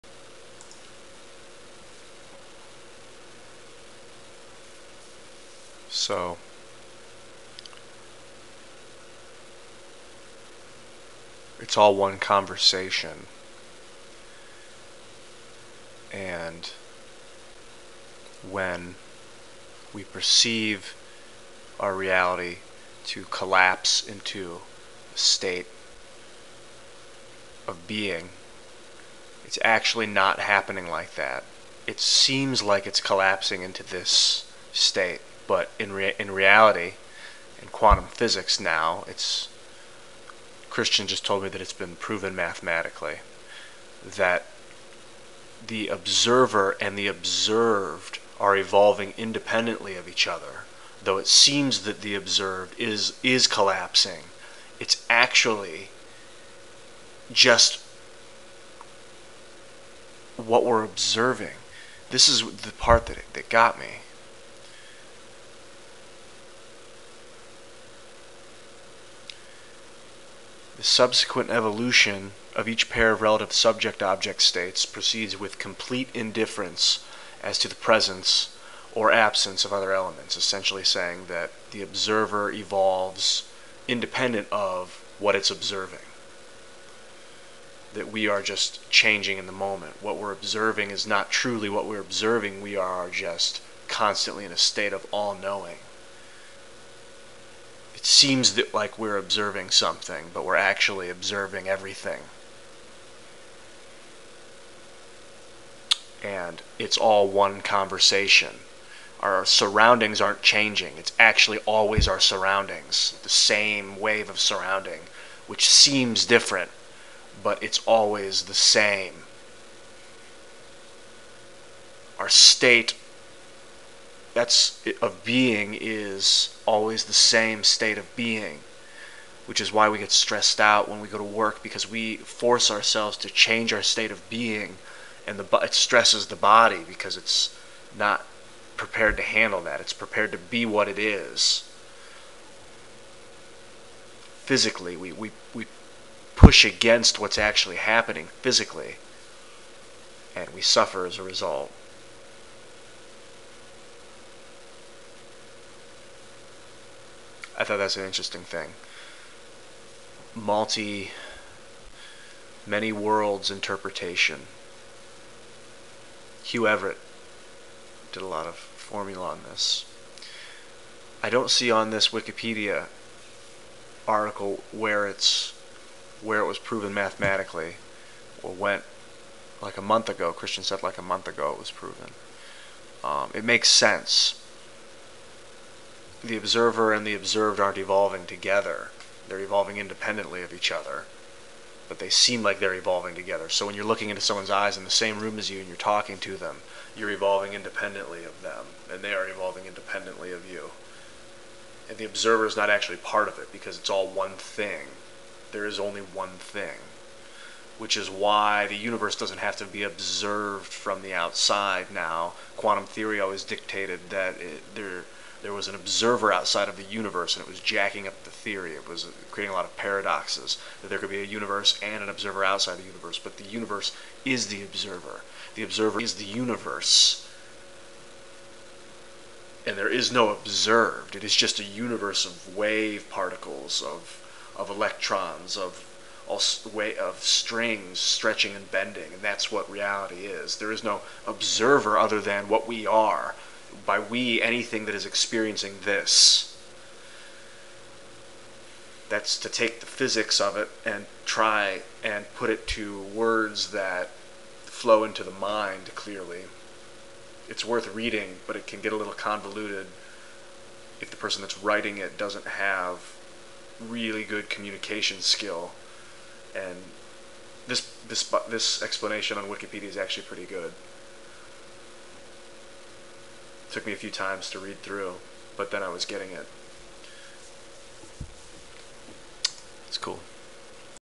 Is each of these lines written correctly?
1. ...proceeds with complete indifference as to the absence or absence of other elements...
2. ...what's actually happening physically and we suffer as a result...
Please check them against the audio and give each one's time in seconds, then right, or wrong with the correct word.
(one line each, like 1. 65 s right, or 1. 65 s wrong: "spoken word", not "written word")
1. 74 s wrong: "presence", not "absence"
2. 147 s right.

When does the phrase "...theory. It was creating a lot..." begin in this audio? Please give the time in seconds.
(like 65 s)
218 s.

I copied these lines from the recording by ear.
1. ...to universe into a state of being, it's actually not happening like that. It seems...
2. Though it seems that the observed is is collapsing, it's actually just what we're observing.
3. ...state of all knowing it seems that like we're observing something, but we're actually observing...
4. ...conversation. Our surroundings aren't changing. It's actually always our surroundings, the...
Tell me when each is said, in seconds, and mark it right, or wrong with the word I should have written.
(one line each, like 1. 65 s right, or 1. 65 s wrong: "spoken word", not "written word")
1. 23 s wrong: "collapse", not "universe"
2. 51 s right
3. 94 s right
4. 107 s right.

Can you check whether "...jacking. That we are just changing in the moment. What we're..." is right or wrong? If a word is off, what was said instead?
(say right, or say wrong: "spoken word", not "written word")
wrong: "observing", not "jacking".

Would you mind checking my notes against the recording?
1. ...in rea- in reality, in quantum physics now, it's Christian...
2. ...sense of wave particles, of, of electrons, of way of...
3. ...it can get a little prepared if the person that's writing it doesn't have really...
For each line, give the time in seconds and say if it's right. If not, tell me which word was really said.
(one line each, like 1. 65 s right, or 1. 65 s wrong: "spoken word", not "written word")
1. 35 s right
2. 231 s wrong: "universe", not "sense"
3. 258 s wrong: "convoluted", not "prepared".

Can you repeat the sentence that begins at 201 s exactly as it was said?
And the observer is not actually part of it because it's all one thing.